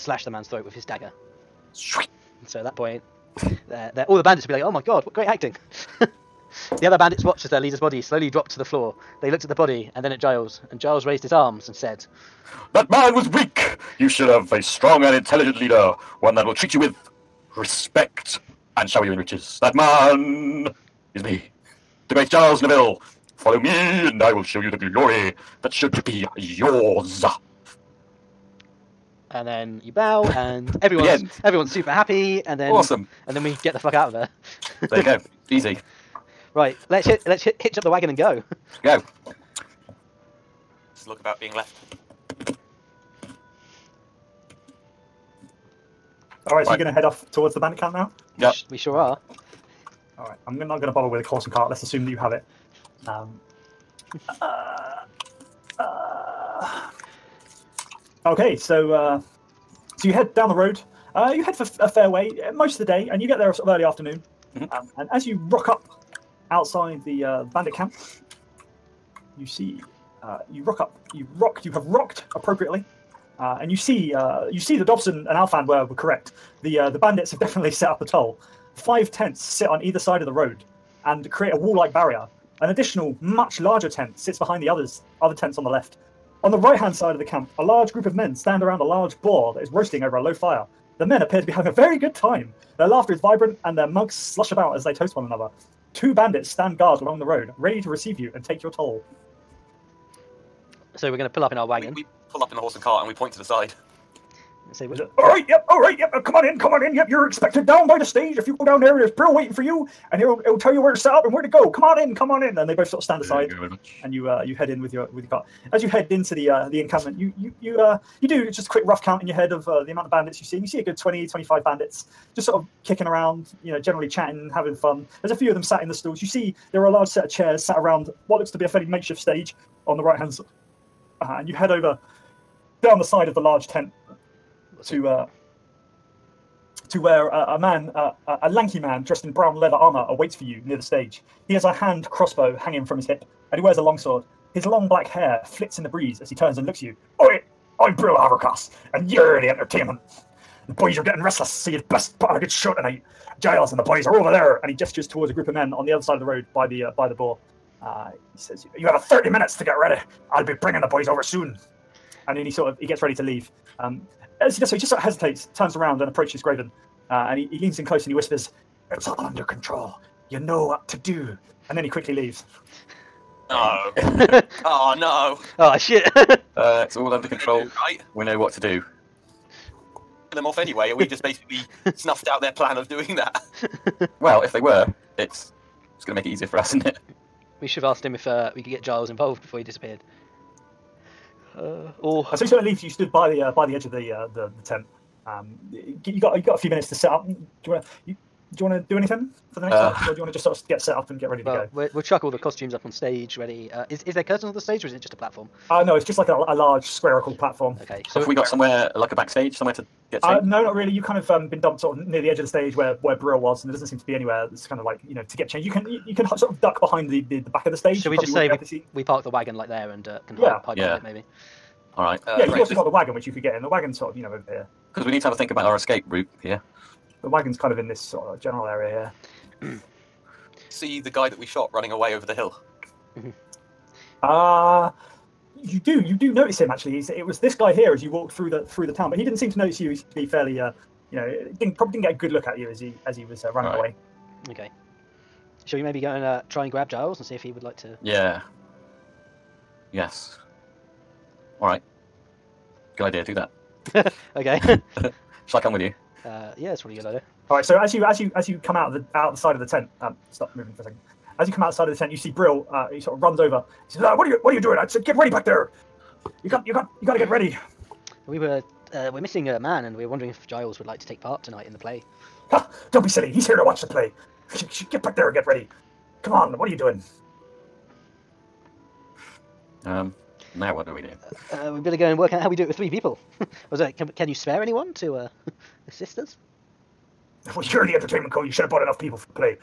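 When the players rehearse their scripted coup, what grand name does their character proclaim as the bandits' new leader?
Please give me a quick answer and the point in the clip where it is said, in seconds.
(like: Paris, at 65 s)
Charles Neville, at 22 s.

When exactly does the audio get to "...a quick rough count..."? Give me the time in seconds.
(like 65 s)
118 s.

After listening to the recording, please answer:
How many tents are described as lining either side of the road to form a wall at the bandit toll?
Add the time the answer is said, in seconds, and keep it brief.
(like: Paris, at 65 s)
5, at 78 s.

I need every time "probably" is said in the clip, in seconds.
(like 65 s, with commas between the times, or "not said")
241 s, 256 s.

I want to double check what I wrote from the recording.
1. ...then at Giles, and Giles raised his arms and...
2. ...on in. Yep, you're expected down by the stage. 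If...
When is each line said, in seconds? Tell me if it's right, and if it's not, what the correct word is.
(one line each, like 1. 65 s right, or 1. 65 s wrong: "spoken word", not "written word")
1. 10 s right
2. 106 s right.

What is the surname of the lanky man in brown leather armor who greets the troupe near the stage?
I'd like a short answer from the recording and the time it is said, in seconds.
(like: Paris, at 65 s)
Havercross, at 148 s.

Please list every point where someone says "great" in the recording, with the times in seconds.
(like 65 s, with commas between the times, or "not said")
5 s, 22 s.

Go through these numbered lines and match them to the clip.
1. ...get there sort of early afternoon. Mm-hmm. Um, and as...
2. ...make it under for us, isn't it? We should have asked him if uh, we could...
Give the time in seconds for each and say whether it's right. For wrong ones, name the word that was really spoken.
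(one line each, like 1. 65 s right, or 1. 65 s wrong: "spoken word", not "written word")
1. 63 s right
2. 186 s wrong: "easier", not "under".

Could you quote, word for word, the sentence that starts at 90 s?
The men appear to be having a very good time.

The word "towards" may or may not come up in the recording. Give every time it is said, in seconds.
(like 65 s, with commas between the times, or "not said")
47 s, 155 s.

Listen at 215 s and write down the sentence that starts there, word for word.
You can you, you can sort of duck behind the, the, the back of the stage.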